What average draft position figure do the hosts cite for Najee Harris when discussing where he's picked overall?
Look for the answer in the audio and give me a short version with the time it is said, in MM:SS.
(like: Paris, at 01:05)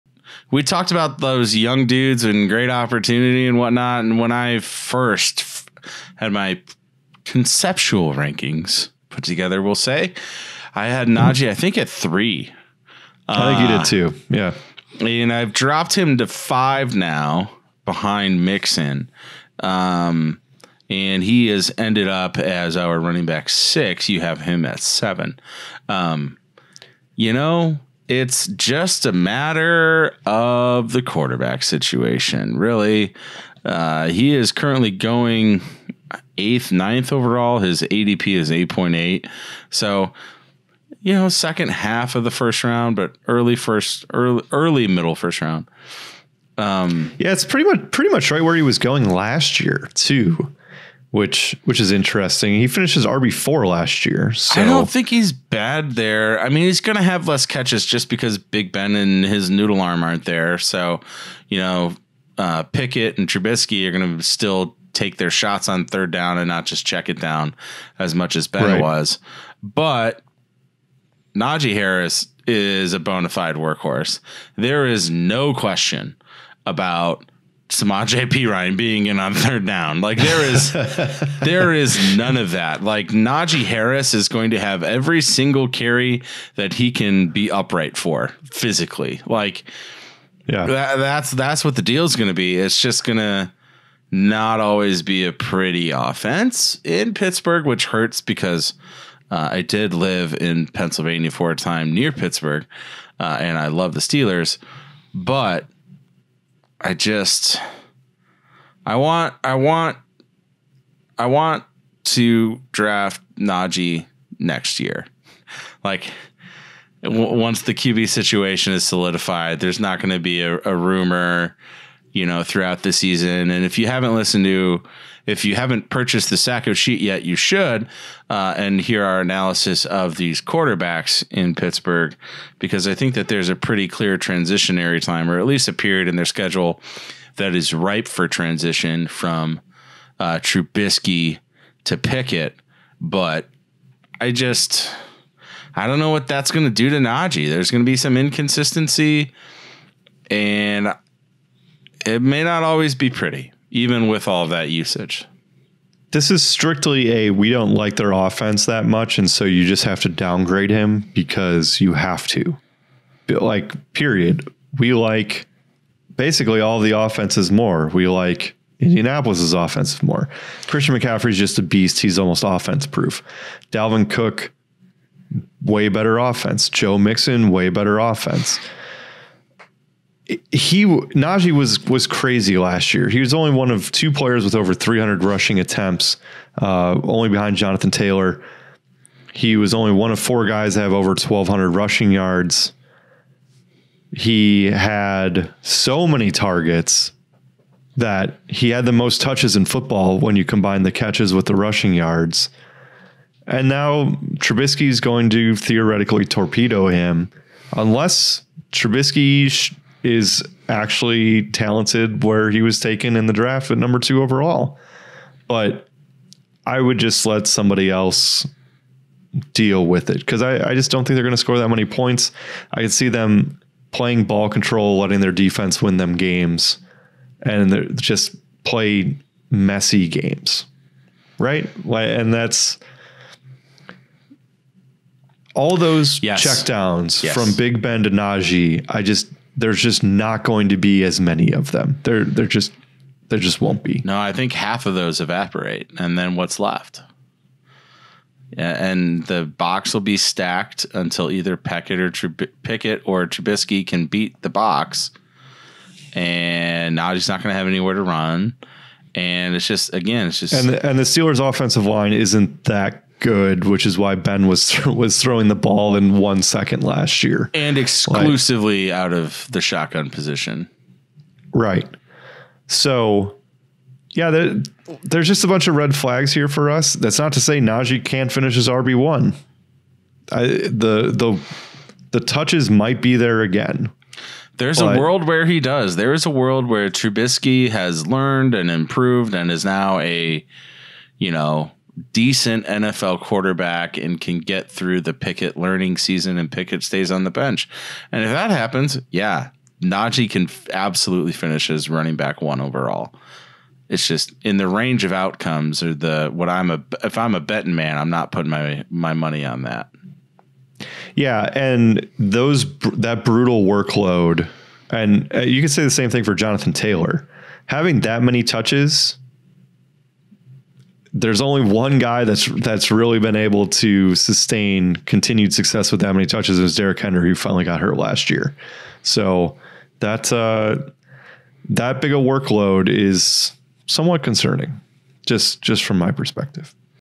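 8.8, at 00:38.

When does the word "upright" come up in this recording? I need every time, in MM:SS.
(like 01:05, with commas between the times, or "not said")
01:27.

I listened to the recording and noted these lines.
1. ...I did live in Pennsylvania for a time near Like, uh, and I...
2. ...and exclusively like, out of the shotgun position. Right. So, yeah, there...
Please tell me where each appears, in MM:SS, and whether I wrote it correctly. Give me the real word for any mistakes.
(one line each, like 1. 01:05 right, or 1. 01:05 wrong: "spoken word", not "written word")
1. 01:39 wrong: "Pittsburgh", not "Like"
2. 04:27 right.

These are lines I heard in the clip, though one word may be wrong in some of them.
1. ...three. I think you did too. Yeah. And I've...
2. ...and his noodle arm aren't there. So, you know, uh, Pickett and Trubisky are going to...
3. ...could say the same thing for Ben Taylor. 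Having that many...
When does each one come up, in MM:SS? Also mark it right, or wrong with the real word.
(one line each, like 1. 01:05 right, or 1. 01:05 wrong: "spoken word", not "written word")
1. 00:11 right
2. 00:58 right
3. 05:15 wrong: "Jonathan", not "Ben".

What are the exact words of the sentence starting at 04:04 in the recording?
No, I think half of those evaporate, and then what's left?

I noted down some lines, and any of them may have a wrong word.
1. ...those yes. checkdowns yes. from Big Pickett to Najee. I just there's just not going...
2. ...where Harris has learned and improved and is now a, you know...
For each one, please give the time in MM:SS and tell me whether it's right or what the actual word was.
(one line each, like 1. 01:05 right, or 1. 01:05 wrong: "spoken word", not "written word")
1. 03:55 wrong: "Ben", not "Pickett"
2. 04:46 wrong: "Trubisky", not "Harris".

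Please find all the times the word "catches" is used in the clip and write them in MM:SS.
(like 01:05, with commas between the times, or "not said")
00:57, 03:20.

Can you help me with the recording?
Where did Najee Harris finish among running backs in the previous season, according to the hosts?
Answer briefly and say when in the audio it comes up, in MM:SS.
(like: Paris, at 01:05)
RB4, at 00:53.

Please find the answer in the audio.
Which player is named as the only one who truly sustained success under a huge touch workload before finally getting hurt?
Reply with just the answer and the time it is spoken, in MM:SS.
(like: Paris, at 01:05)
Derrick Henry, at 05:26.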